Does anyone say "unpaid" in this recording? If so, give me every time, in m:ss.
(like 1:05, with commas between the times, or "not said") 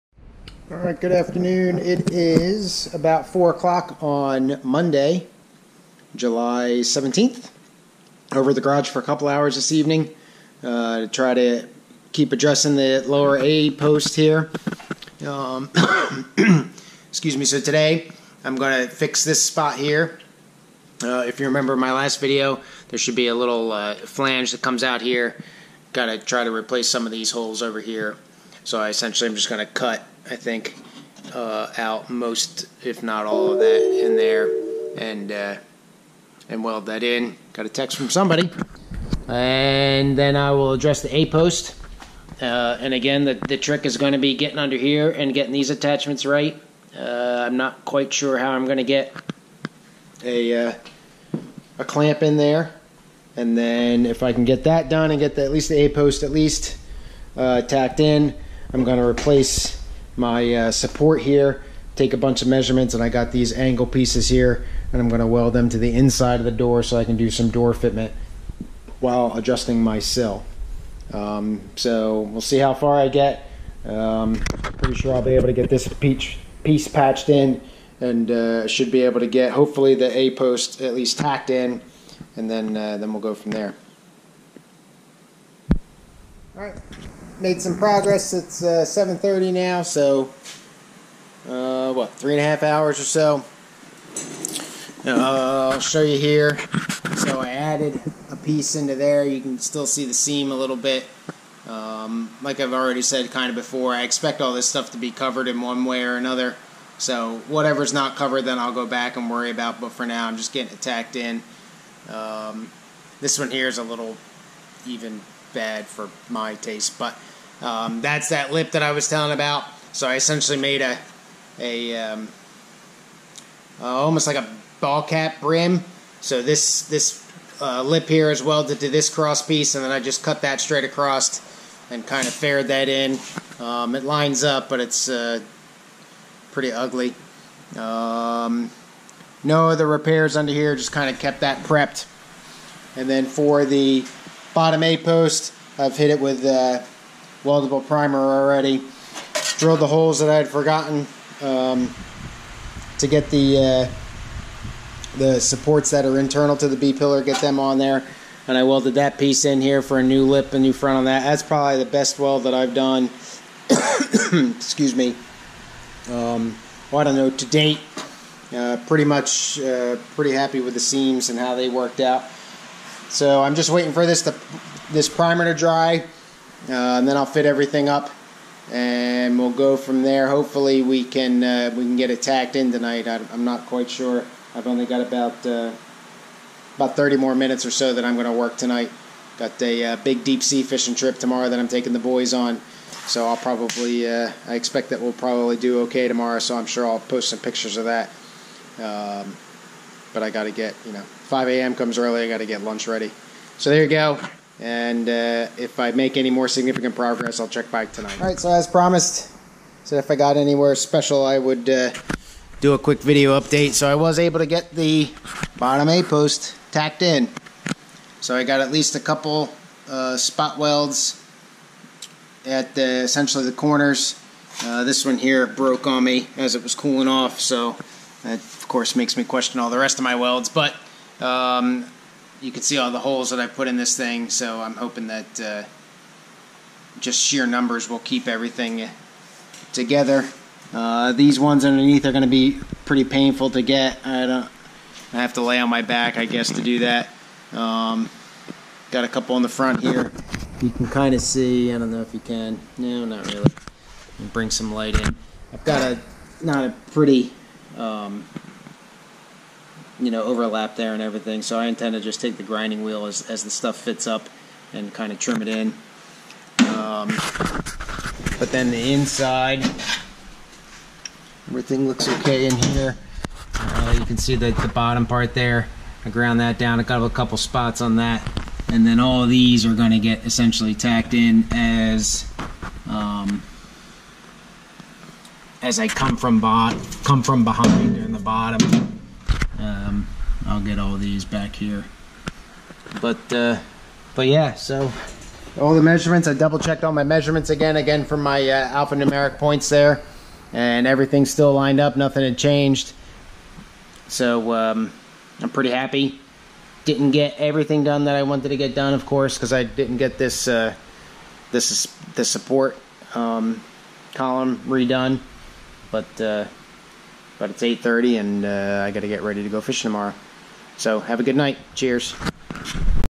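not said.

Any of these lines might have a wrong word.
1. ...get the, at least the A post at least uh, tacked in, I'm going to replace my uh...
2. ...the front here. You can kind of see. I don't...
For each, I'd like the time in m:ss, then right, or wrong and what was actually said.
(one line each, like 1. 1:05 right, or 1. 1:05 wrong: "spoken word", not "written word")
1. 0:55 right
2. 4:09 right.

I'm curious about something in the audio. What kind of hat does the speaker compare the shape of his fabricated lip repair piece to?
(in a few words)
ball cap.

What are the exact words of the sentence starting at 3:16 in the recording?
So I'm sure I'll post some pictures of that.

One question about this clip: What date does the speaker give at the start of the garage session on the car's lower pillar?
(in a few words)
Monday, July 17th.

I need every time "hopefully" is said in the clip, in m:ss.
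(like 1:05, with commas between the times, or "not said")
1:19, 3:00.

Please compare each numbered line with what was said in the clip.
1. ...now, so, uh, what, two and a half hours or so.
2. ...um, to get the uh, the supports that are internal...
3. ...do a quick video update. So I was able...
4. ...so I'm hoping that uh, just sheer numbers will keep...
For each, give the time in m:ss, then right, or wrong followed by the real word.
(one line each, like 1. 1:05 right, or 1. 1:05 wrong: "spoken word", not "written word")
1. 1:29 wrong: "three", not "two"
2. 2:31 right
3. 3:32 right
4. 3:54 right.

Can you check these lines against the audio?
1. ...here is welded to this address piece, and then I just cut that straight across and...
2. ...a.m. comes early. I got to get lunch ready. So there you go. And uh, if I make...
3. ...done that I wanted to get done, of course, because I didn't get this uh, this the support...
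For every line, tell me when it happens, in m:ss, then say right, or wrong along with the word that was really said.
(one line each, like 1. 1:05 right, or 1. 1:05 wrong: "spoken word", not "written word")
1. 2:08 wrong: "cross", not "address"
2. 3:21 right
3. 5:07 right.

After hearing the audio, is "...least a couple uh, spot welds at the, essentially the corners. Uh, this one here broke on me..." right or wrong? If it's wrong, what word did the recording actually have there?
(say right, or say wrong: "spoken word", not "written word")
right.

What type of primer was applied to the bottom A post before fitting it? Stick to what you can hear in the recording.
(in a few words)
weldable primer.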